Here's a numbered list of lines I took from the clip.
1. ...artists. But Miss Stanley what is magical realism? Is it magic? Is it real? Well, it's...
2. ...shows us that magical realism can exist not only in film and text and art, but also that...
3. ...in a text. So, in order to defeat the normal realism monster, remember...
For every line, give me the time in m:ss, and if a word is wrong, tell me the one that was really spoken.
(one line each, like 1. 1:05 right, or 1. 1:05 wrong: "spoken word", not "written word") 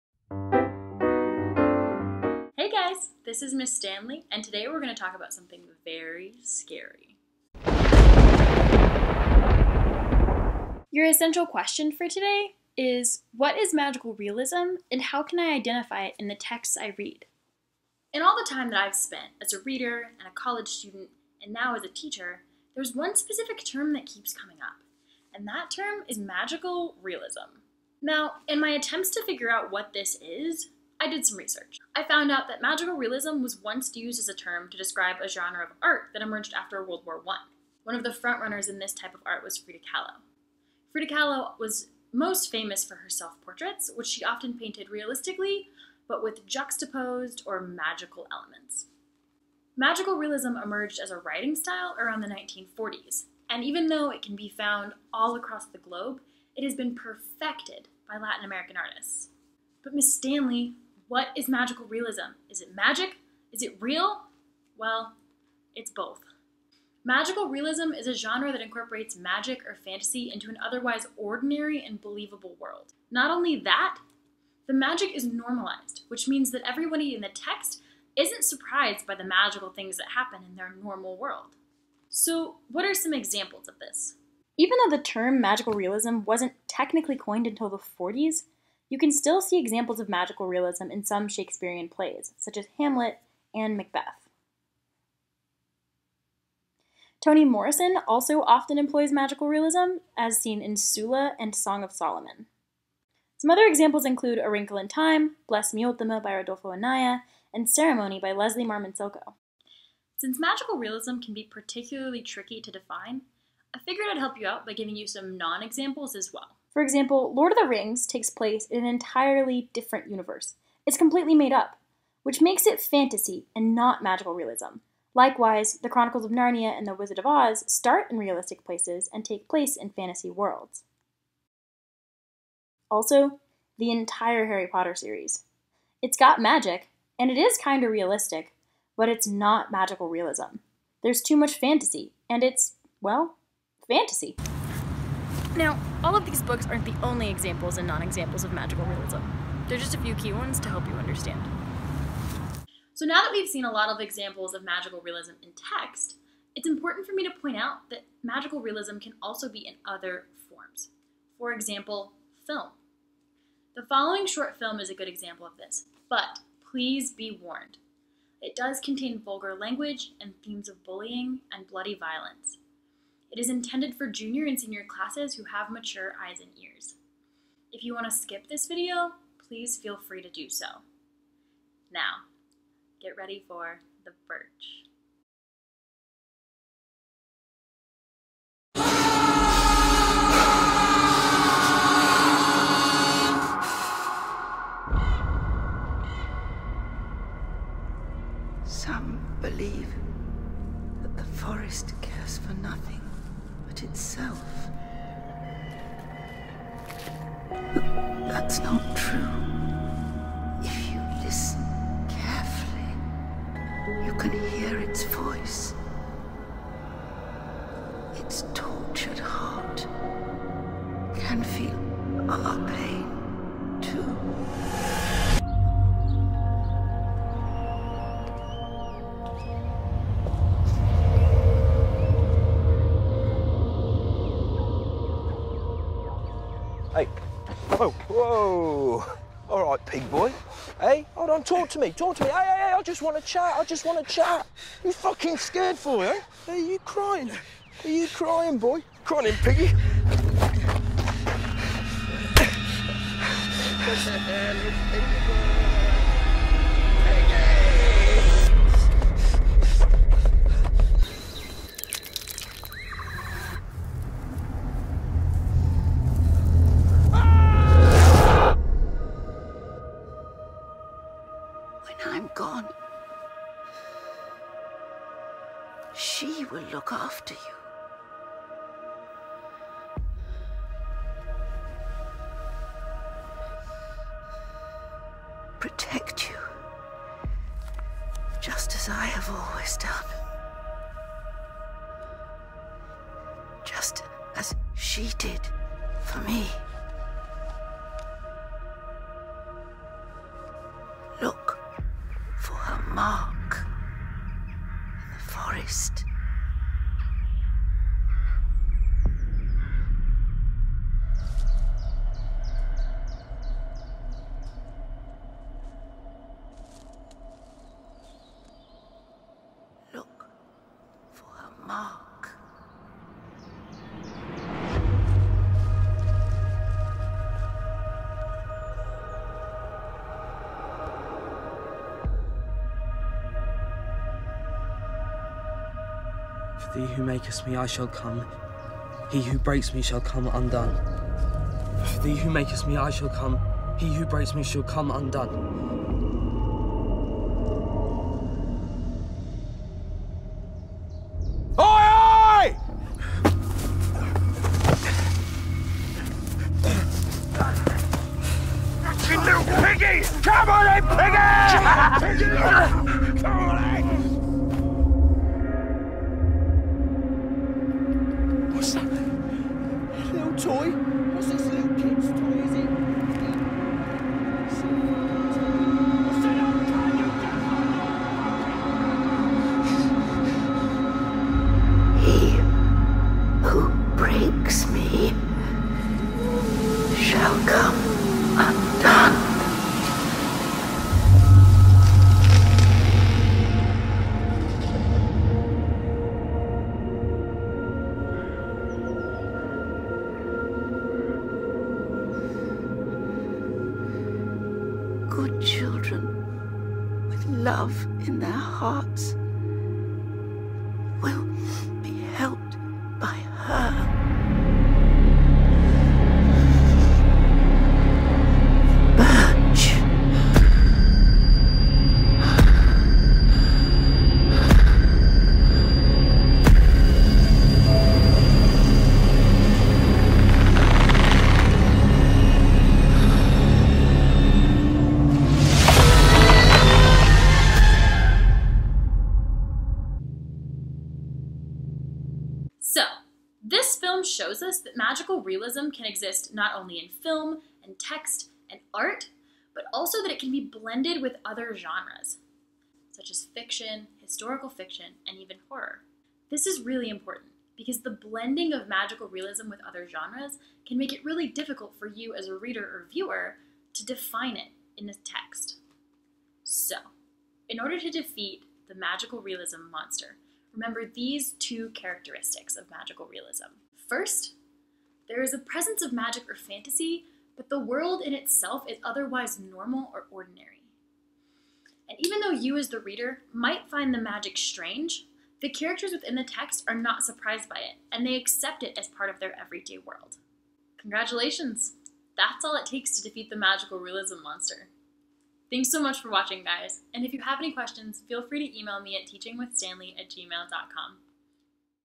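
1. 0:58 right
2. 7:24 right
3. 7:44 wrong: "magical", not "normal".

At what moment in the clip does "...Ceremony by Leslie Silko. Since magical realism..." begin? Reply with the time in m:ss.
1:47.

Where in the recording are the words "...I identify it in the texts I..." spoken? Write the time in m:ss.
0:15.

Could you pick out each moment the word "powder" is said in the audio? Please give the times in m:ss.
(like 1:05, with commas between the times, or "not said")
not said.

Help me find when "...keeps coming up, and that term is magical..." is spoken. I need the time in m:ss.
0:24.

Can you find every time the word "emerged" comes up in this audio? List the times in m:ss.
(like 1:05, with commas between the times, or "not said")
0:36, 0:50.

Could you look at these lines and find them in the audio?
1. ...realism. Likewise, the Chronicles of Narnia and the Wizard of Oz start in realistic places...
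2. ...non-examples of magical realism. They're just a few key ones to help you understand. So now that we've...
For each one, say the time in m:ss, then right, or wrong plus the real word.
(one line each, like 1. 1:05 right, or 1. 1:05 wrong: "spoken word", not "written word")
1. 2:04 right
2. 2:27 right.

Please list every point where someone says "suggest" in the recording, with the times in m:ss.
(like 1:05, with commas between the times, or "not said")
not said.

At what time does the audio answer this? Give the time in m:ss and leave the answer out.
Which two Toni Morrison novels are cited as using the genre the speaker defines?
1:40.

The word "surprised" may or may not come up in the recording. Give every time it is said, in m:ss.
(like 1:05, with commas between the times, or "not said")
1:18, 8:07.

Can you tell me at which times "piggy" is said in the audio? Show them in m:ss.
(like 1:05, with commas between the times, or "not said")
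4:09, 4:14.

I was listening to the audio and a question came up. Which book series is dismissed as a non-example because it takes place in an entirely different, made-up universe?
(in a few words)
Lord of the Rings.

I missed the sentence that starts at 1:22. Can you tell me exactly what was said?
So, what are some examples of this?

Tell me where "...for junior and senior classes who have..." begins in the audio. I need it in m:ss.
2:53.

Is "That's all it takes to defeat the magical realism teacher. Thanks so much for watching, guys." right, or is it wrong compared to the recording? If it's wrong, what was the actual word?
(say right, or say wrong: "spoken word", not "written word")
wrong: "monster", not "teacher".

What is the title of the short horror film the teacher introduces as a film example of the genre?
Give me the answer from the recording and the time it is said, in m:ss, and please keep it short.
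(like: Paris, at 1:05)
The Birch, at 3:04.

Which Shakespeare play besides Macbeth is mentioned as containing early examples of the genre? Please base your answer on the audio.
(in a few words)
Hamlet.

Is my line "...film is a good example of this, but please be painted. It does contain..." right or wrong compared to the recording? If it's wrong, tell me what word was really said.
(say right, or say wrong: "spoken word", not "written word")
wrong: "warned", not "painted".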